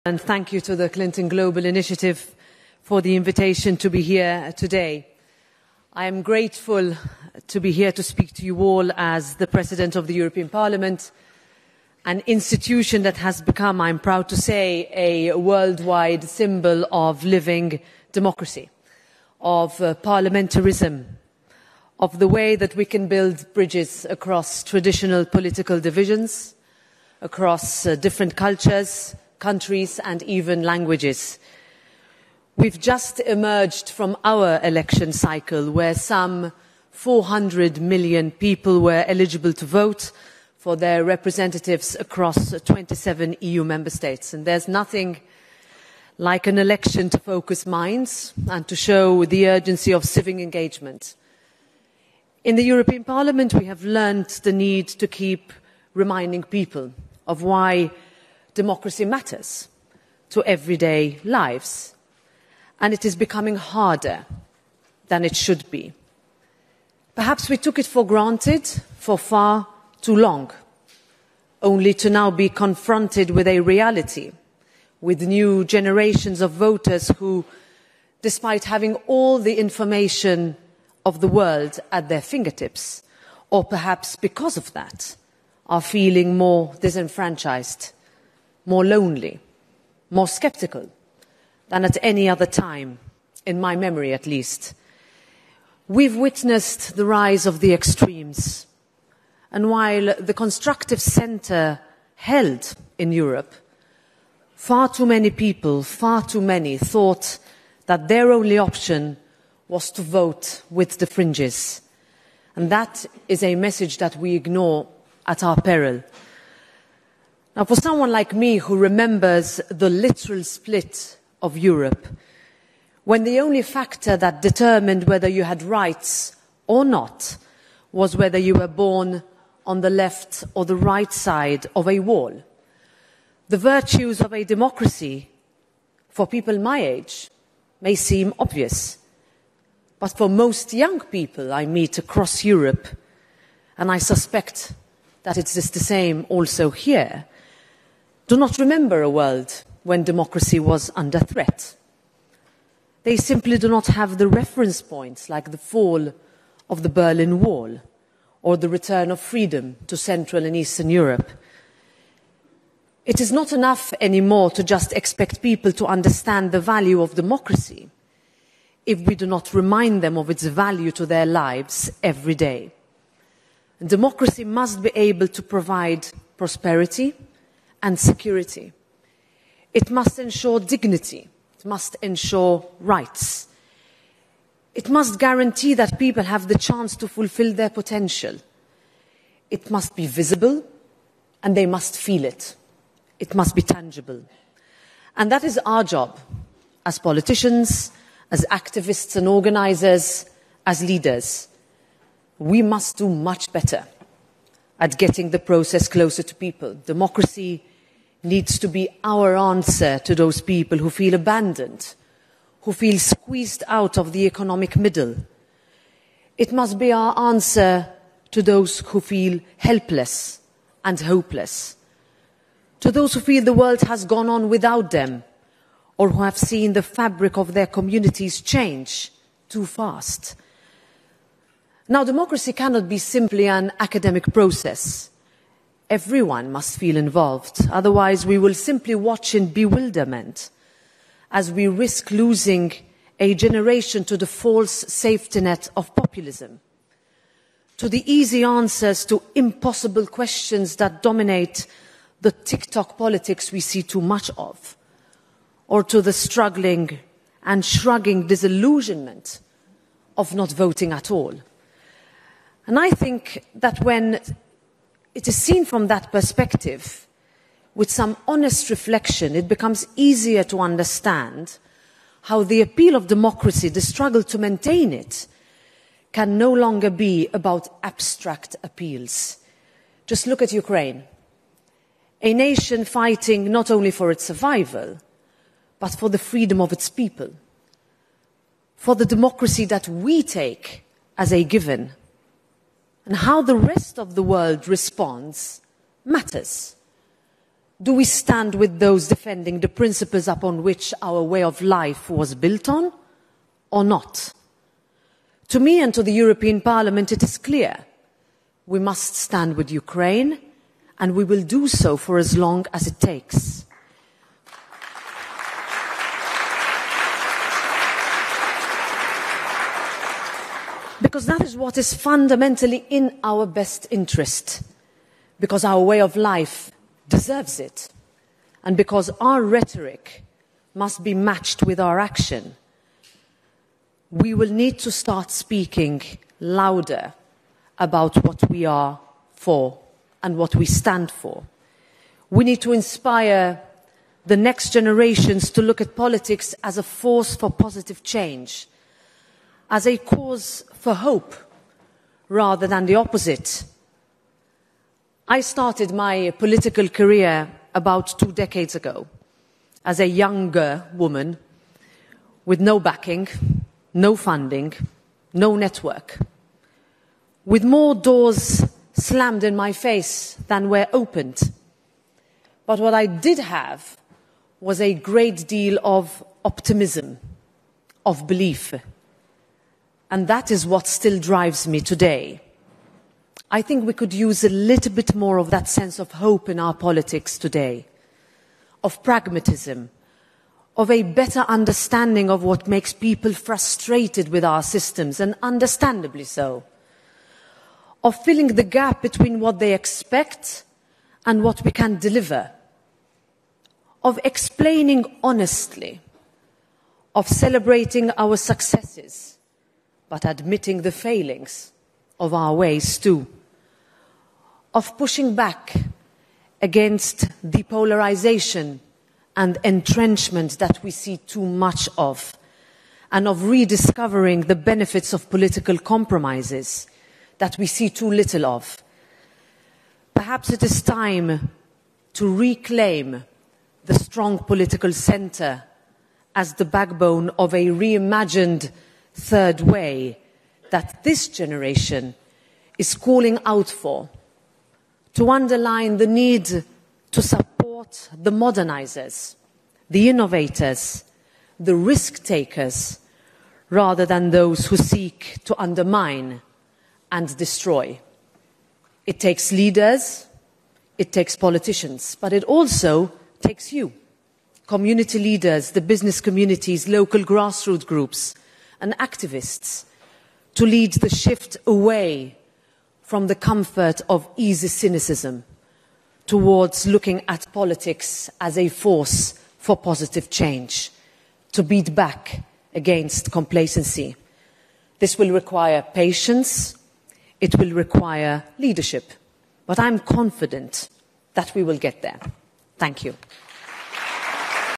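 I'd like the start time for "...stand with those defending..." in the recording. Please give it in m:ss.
4:58.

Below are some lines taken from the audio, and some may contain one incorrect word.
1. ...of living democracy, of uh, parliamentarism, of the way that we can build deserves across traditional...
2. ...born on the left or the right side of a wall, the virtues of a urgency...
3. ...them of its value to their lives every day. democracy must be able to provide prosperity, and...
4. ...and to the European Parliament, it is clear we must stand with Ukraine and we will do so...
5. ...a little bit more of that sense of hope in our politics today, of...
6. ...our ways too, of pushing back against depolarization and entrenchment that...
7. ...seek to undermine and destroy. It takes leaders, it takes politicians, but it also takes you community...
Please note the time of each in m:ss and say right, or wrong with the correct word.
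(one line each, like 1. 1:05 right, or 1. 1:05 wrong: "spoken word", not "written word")
1. 0:16 wrong: "bridges", not "deserves"
2. 2:08 wrong: "democracy", not "urgency"
3. 2:50 right
4. 5:05 right
5. 6:24 right
6. 6:52 right
7. 7:34 right.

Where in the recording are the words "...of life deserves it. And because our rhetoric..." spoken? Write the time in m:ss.
5:25.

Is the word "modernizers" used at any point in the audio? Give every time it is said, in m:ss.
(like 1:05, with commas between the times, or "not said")
7:28.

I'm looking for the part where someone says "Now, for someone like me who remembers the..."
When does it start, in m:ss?
1:57.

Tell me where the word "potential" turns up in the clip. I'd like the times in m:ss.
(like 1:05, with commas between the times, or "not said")
3:07.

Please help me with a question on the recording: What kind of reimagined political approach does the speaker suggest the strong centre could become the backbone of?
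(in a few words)
third way.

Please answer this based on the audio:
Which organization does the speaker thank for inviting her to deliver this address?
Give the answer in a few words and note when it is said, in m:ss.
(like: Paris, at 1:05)
Clinton Global Initiative, at 0:00.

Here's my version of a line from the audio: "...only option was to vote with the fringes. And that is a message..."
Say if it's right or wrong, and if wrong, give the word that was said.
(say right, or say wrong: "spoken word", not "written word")
right.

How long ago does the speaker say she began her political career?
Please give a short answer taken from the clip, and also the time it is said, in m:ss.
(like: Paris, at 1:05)
about two decades ago, at 5:57.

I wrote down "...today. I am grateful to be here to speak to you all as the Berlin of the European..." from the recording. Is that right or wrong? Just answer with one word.
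wrong.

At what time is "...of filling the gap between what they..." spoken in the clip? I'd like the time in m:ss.
6:38.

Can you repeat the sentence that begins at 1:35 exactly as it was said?
We've witnessed the rise of the extremes.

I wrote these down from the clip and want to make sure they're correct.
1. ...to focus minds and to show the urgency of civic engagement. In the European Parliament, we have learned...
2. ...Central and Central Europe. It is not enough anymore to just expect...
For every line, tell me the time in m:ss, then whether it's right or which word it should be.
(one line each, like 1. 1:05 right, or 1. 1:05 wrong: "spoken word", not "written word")
1. 0:47 right
2. 2:39 wrong: "Eastern", not "Central".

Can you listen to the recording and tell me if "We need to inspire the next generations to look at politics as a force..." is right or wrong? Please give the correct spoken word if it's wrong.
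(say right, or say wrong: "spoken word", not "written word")
right.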